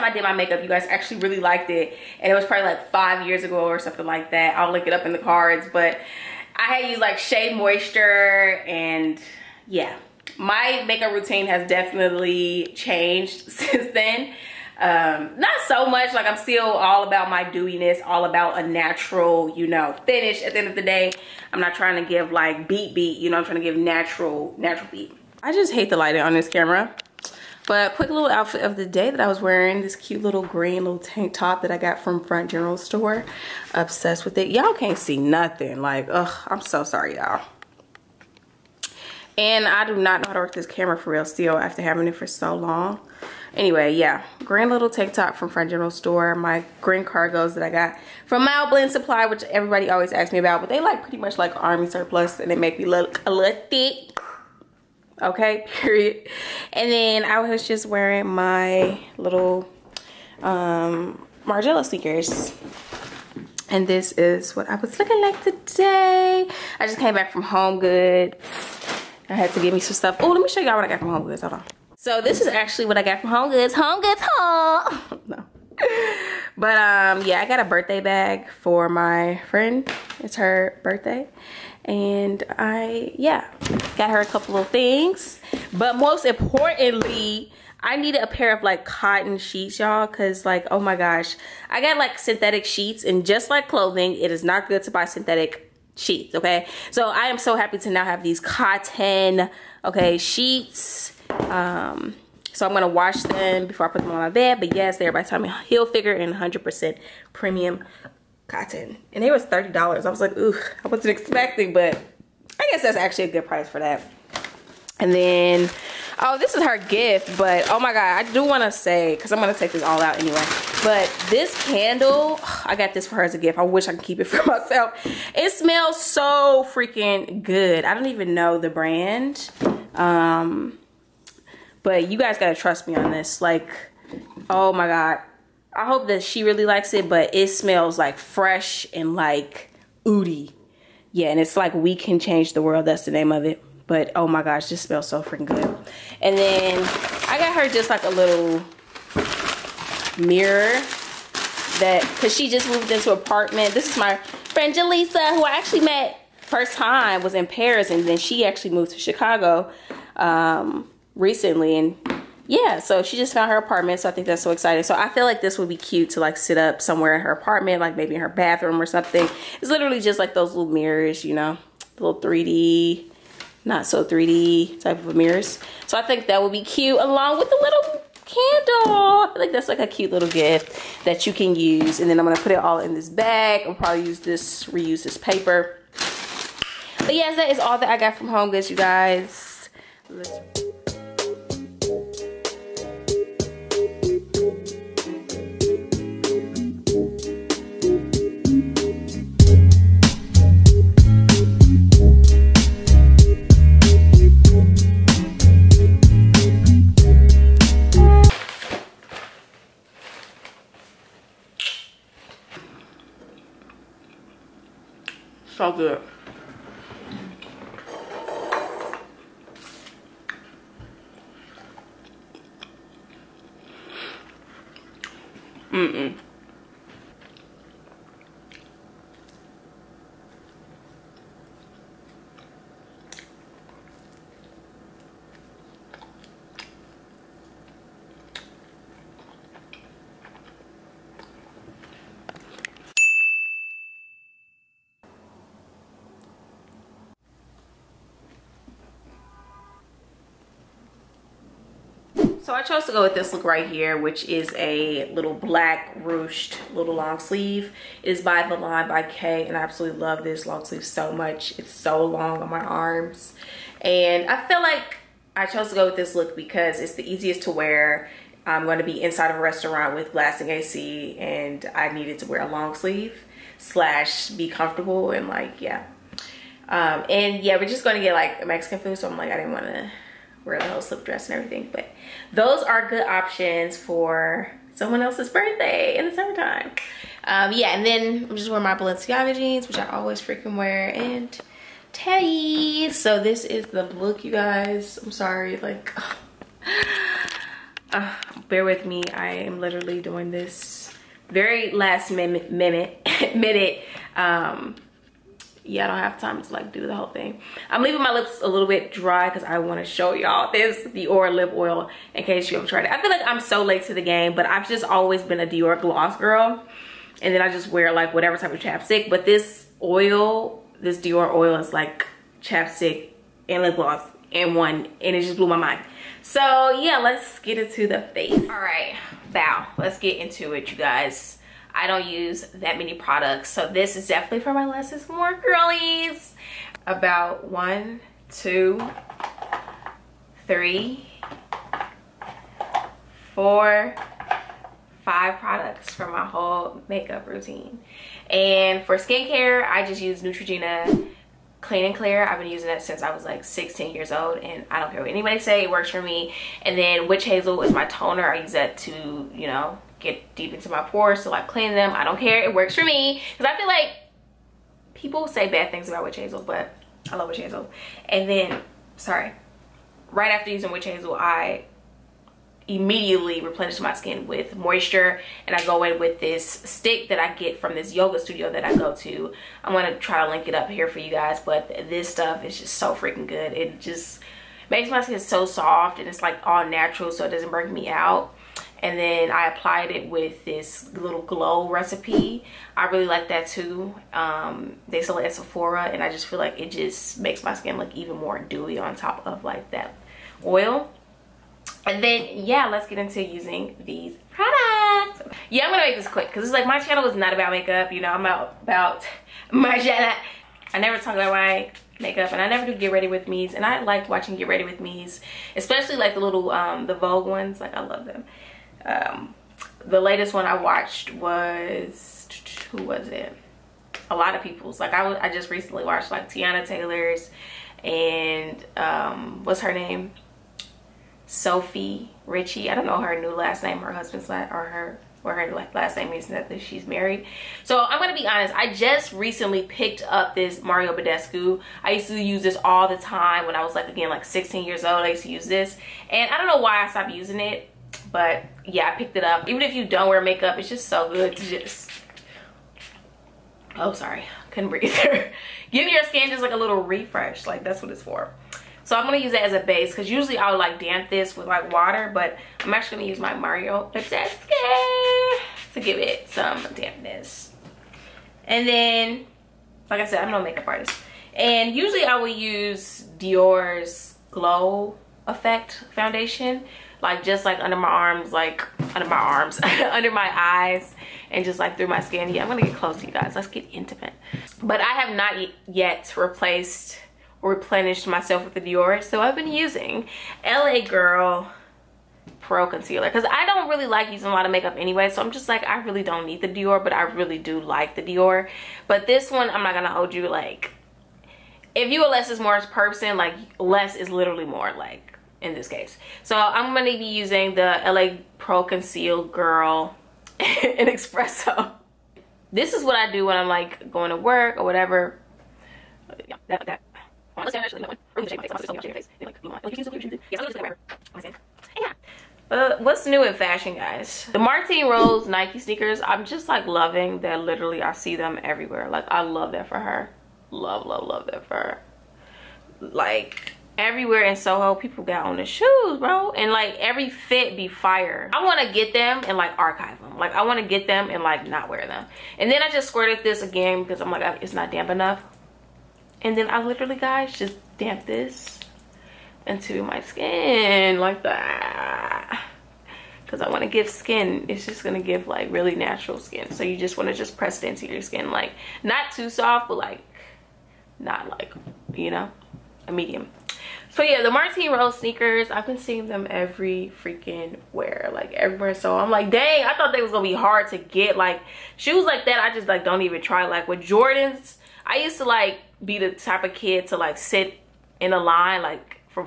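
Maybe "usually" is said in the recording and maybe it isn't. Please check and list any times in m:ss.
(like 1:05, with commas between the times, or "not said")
7:40, 7:51.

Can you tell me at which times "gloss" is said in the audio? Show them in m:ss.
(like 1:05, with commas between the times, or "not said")
5:15, 5:23.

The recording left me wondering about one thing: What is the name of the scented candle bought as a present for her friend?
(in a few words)
We can change the world.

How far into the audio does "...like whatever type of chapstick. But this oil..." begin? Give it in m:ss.
5:17.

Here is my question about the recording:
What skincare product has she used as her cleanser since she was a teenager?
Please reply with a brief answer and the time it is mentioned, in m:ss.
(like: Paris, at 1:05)
Neutrogena Clean and Clear, at 5:50.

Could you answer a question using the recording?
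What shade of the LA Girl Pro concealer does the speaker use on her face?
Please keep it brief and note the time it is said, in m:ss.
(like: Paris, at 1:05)
Espresso, at 8:30.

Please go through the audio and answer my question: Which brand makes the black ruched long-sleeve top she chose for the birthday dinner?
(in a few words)
The Line by K.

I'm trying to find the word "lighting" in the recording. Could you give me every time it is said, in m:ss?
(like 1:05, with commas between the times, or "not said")
0:25.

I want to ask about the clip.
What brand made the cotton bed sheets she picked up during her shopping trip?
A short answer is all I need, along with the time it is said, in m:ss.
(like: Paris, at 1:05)
Tommy Hilfiger, at 1:45.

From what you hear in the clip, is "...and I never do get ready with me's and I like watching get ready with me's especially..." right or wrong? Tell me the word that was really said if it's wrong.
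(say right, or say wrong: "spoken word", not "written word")
right.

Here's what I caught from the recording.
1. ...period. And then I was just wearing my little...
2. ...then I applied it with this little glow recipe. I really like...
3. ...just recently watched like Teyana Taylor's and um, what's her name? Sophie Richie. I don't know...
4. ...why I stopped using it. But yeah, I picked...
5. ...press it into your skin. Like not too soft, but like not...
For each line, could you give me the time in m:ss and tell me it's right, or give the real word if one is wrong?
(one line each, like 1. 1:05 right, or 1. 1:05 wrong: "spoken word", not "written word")
1. 0:55 right
2. 6:28 right
3. 7:05 right
4. 7:26 right
5. 9:17 right.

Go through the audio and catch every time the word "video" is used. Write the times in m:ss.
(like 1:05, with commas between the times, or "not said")
not said.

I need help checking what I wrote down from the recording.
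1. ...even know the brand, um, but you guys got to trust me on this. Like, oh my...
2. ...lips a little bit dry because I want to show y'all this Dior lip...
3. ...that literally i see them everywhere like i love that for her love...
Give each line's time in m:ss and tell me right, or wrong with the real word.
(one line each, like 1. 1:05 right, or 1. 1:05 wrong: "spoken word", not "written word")
1. 2:08 right
2. 5:08 right
3. 8:47 right.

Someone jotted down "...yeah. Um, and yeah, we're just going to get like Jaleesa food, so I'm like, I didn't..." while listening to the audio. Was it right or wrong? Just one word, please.
wrong.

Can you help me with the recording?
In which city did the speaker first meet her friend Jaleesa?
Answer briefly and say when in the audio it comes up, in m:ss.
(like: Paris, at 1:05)
Paris, at 2:37.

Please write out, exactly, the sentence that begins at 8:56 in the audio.
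And like every fit be fire.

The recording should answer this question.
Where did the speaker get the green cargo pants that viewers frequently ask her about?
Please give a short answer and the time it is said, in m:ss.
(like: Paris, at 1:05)
Mild Blend Supply, at 0:48.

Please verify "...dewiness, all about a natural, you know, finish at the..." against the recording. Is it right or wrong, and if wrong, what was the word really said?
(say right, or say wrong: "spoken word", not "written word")
right.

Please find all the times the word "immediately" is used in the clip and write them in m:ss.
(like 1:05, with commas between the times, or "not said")
6:12.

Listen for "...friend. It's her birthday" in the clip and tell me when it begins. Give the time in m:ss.
1:19.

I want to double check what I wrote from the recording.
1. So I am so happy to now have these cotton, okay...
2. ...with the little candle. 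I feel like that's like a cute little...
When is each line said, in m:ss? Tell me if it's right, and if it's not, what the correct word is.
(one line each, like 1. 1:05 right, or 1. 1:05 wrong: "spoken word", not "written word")
1. 1:36 right
2. 2:57 right.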